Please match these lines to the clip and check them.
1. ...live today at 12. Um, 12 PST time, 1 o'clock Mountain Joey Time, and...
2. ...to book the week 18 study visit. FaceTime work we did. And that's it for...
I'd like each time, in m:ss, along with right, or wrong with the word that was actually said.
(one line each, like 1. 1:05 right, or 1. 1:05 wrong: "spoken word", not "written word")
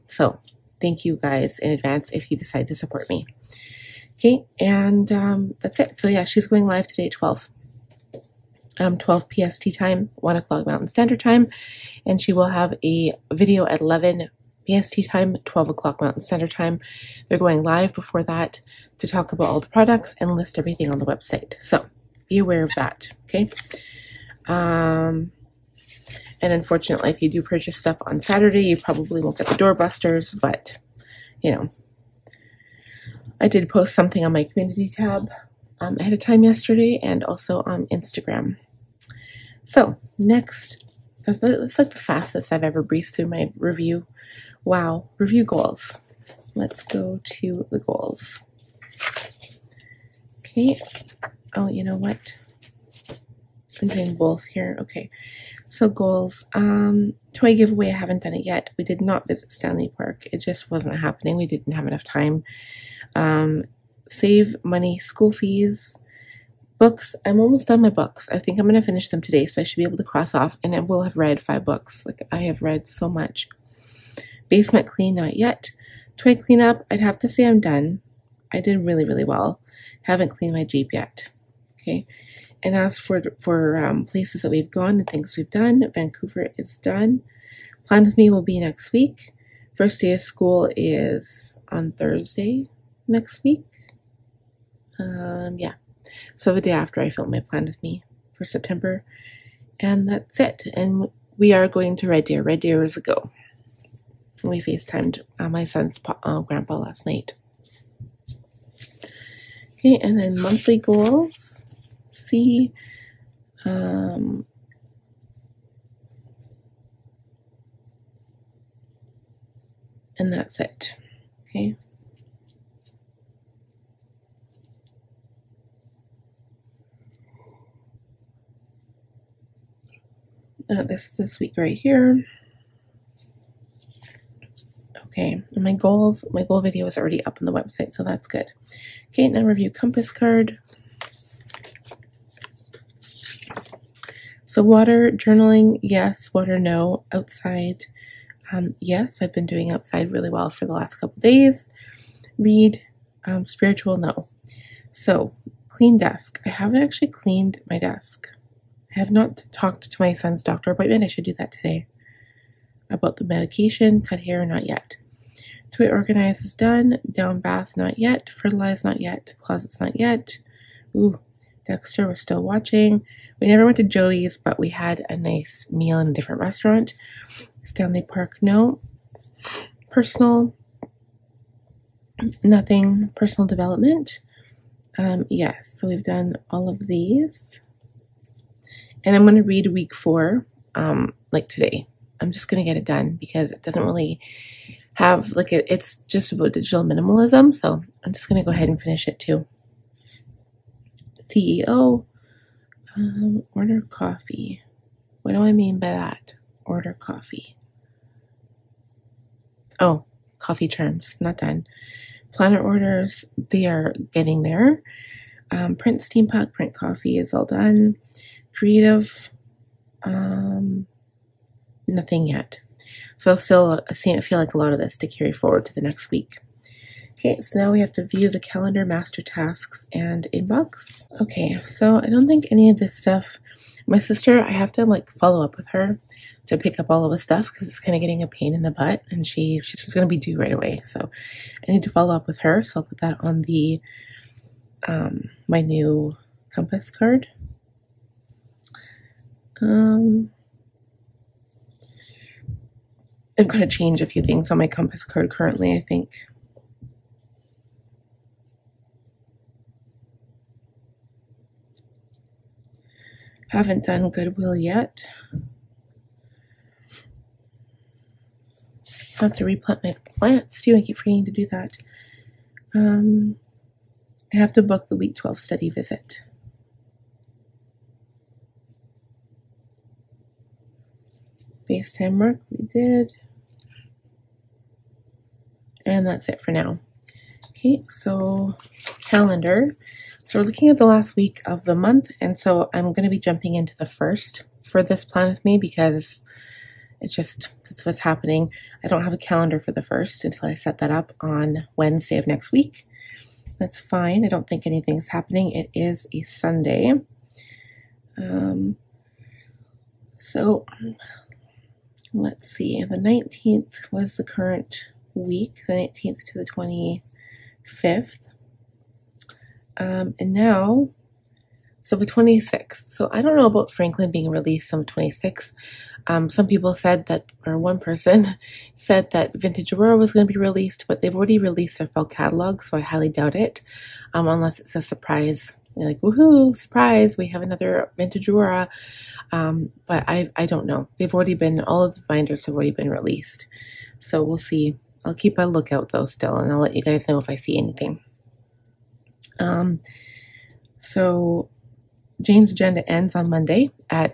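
1. 0:06 wrong: "Standard", not "Joey"
2. 4:34 wrong: "12", not "18".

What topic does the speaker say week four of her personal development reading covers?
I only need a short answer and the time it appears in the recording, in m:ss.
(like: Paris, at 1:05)
Digital minimalism, at 3:16.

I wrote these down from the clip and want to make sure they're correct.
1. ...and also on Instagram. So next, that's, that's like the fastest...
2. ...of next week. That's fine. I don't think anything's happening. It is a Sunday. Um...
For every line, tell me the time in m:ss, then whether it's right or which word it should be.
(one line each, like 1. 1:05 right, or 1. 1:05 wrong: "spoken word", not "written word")
1. 0:37 right
2. 5:02 right.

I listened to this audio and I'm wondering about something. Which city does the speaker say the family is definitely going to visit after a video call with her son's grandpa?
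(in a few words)
Red Deer.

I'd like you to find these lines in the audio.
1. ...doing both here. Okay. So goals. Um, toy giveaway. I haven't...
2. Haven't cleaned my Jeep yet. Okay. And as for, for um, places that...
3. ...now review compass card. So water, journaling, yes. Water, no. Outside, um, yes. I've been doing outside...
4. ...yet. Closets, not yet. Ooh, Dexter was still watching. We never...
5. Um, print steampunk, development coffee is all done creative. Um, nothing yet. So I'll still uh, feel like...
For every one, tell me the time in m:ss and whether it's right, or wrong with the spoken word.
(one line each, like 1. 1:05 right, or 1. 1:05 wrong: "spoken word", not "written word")
1. 0:53 right
2. 1:20 right
3. 2:19 right
4. 2:48 right
5. 3:35 wrong: "print", not "development".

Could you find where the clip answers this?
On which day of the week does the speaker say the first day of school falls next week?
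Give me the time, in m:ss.
1:31.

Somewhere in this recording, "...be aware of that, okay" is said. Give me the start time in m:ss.
0:22.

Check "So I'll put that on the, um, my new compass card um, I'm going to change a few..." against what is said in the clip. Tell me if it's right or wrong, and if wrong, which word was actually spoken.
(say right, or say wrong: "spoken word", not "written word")
right.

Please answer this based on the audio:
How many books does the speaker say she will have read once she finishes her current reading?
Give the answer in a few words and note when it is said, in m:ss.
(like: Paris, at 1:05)
5, at 1:11.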